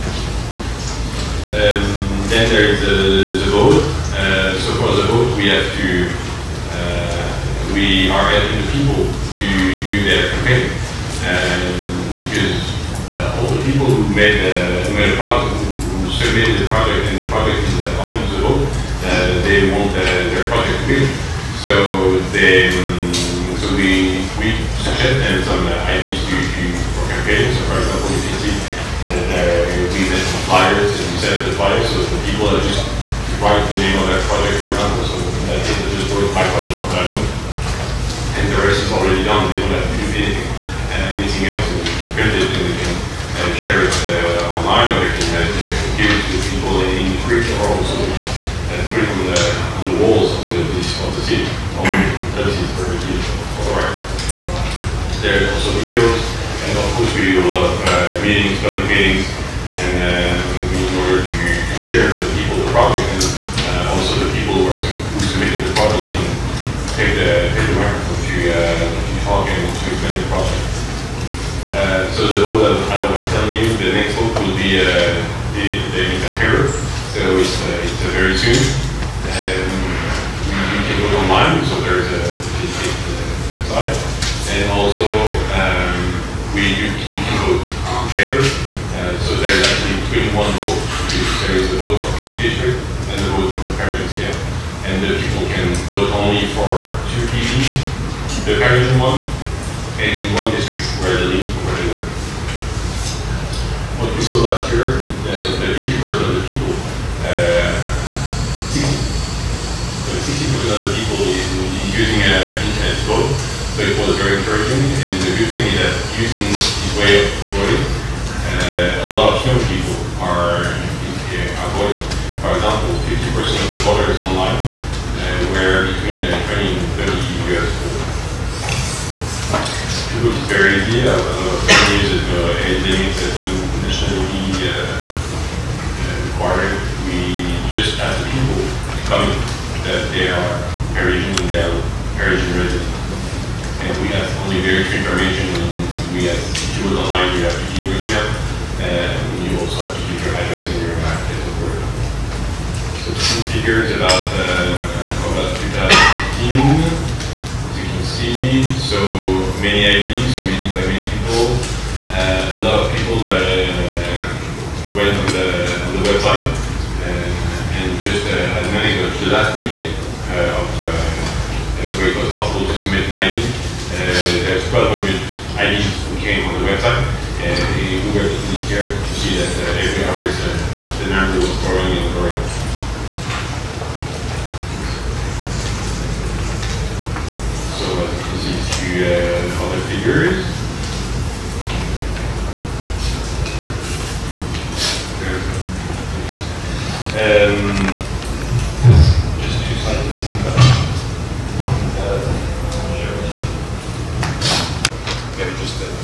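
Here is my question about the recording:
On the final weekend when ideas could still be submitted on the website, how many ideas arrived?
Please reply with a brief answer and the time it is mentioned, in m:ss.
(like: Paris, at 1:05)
1,200, at 2:54.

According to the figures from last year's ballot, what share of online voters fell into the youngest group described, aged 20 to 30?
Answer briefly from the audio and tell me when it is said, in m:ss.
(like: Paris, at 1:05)
50%, at 2:03.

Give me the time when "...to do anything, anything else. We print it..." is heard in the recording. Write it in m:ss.
0:39.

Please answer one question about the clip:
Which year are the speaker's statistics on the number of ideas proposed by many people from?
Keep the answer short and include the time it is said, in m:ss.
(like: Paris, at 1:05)
2015, at 2:35.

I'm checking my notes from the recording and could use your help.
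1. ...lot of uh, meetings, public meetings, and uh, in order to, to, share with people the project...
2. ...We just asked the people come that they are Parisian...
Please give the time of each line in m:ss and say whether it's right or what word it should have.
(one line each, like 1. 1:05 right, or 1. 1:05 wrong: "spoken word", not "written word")
1. 0:57 right
2. 2:17 right.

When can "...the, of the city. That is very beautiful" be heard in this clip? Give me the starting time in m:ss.
0:50.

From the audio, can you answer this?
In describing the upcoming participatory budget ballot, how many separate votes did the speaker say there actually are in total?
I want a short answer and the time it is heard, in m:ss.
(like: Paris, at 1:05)
21, at 1:30.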